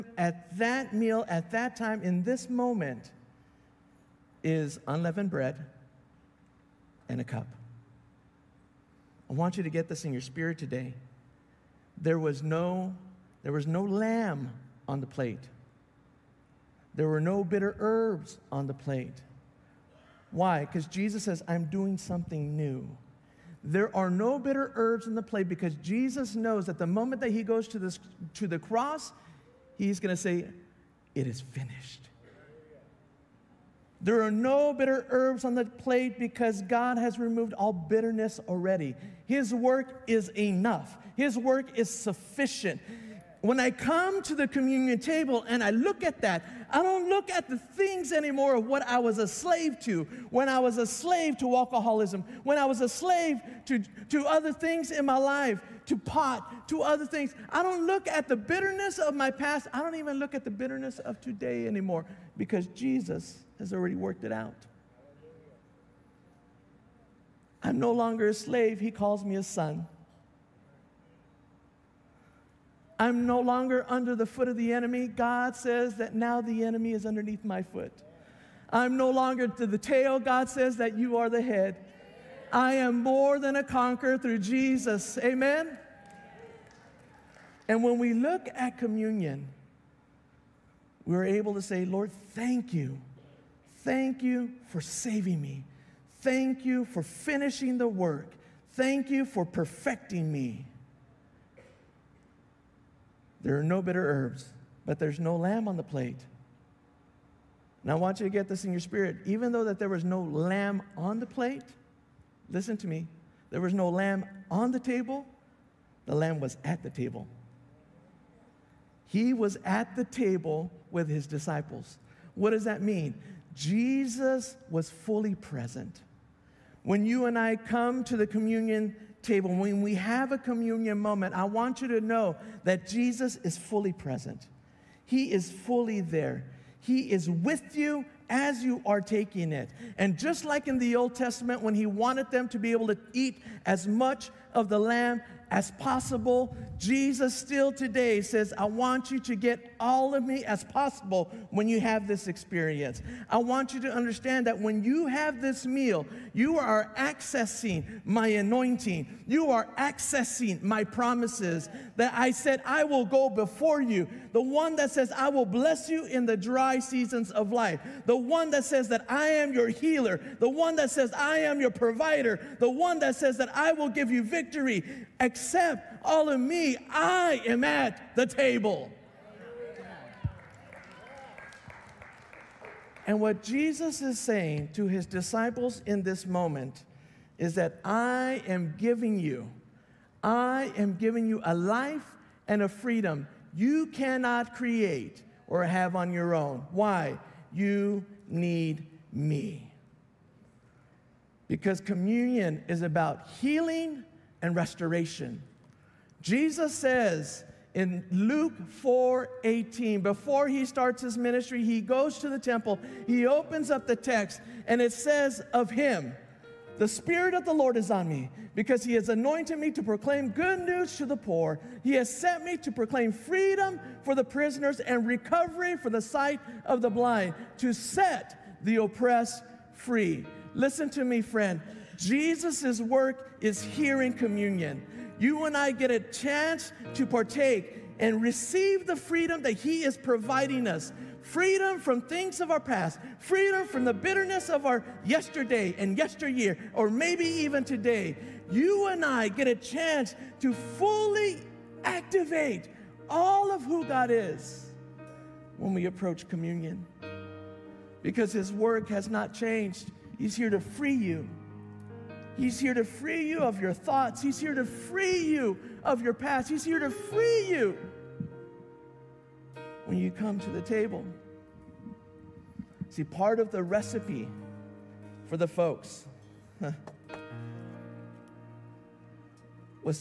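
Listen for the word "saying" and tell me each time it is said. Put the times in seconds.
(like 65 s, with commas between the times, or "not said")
184 s.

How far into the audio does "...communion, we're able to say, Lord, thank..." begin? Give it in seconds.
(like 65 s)
88 s.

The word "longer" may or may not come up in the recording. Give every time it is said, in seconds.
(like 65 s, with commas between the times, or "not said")
67 s, 73 s, 79 s.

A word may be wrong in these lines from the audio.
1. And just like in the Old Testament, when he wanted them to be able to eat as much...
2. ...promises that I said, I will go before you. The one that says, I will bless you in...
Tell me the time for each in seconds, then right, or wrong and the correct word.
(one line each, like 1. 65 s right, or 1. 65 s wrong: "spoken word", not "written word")
1. 139 s right
2. 160 s right.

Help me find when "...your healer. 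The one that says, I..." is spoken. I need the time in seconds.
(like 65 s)
169 s.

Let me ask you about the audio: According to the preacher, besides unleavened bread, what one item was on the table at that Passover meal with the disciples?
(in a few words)
A cup.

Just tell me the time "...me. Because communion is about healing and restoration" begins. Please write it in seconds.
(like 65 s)
199 s.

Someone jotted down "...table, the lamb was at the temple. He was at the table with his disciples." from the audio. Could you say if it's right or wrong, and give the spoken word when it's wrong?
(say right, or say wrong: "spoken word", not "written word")
wrong: "table", not "temple".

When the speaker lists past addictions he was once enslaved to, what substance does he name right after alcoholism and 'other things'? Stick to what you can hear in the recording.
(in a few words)
Pot.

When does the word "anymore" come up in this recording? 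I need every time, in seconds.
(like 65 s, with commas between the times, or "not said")
48 s, 61 s.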